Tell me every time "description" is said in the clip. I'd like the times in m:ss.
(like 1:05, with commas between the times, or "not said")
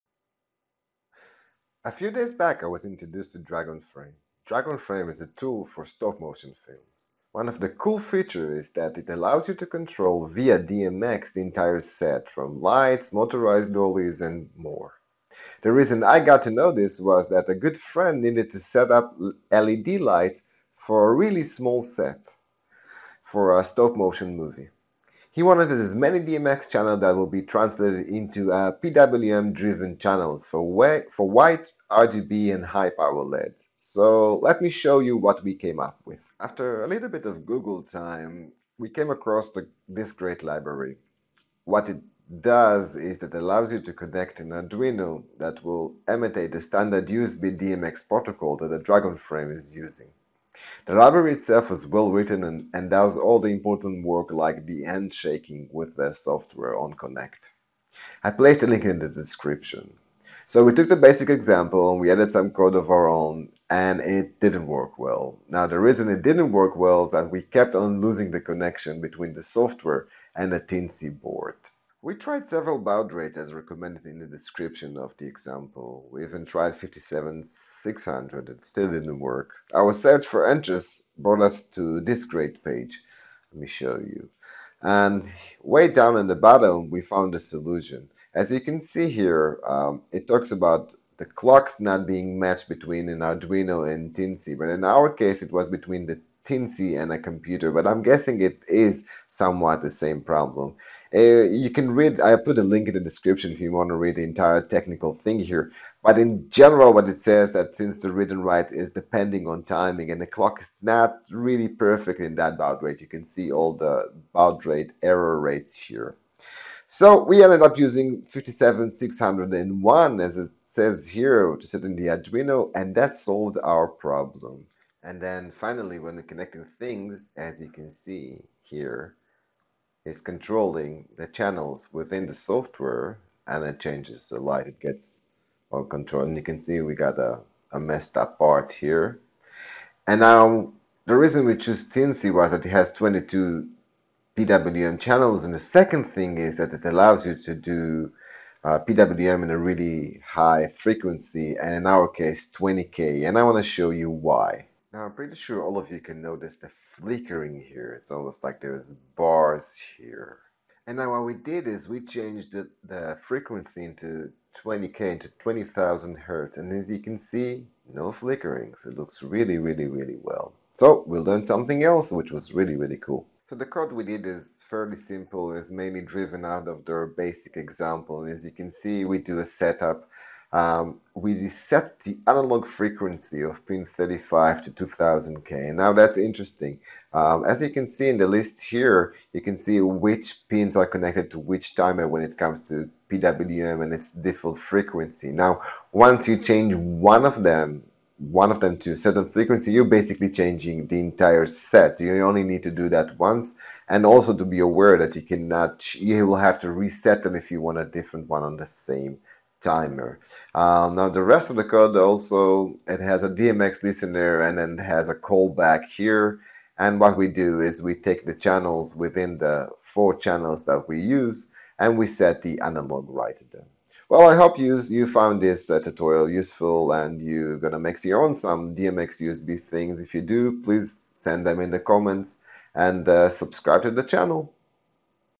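0:59, 1:14, 1:43.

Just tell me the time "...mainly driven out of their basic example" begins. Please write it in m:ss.
2:55.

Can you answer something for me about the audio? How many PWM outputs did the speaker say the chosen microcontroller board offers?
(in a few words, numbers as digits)
22.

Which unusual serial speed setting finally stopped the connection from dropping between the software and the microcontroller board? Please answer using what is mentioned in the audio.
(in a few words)
57601.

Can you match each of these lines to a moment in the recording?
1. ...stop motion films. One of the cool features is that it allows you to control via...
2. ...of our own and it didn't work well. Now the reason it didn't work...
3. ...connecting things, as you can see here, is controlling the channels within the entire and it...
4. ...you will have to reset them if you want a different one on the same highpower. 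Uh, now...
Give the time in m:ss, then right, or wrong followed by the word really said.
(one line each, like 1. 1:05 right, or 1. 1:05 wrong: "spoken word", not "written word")
1. 0:05 right
2. 1:02 right
3. 2:06 wrong: "software", not "entire"
4. 3:25 wrong: "timer", not "highpower".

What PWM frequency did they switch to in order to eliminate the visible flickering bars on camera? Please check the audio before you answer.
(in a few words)
20,000 Hertz.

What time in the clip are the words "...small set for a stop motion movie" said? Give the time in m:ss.
0:21.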